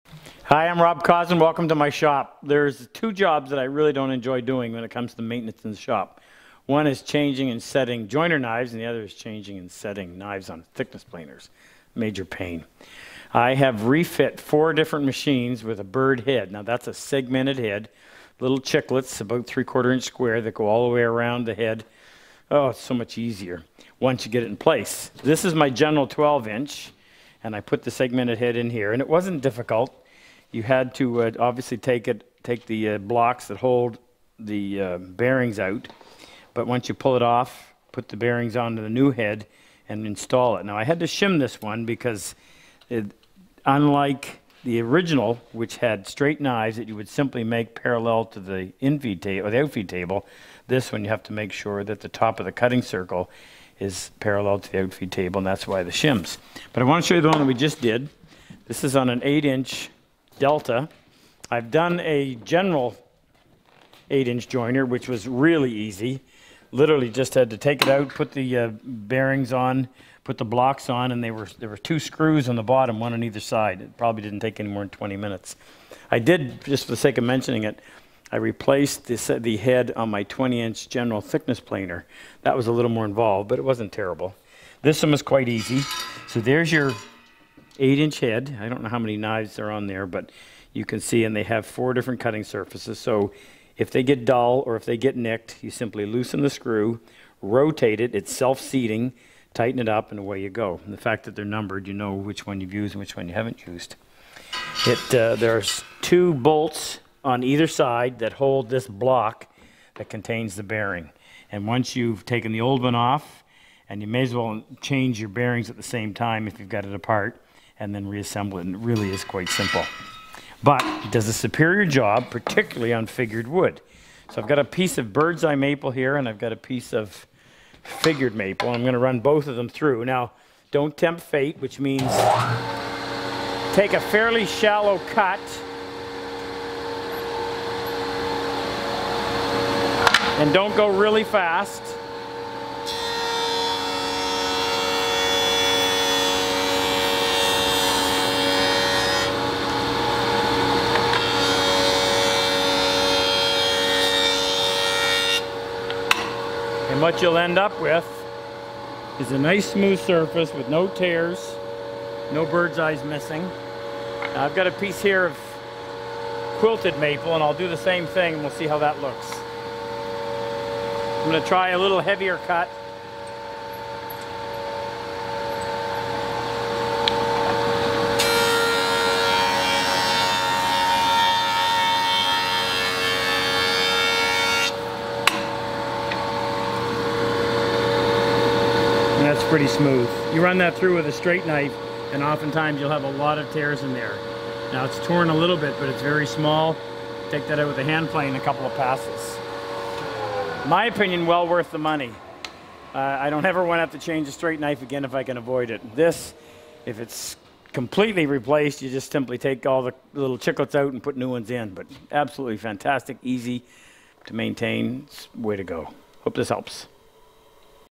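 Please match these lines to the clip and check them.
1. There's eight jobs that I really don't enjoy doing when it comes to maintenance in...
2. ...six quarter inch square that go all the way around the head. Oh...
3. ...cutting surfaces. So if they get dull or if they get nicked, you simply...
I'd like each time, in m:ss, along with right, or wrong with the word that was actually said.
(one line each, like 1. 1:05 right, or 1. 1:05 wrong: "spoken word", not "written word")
1. 0:02 wrong: "two", not "eight"
2. 0:19 wrong: "three", not "six"
3. 1:32 right.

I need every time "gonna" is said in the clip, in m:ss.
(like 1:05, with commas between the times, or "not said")
2:51.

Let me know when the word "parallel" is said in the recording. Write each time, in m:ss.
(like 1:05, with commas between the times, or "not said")
0:47, 0:54.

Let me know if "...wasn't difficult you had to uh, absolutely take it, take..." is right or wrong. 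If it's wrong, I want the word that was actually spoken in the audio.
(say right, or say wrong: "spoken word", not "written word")
wrong: "obviously", not "absolutely".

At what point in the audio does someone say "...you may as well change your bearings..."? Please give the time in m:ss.
1:54.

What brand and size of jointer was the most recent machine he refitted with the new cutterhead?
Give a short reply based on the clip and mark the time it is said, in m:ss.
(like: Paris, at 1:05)
8-inch Delta, at 0:59.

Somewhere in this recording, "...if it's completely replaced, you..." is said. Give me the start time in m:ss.
3:26.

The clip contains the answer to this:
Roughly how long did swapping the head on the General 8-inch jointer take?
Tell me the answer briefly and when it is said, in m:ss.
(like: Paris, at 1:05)
20 minutes, at 1:14.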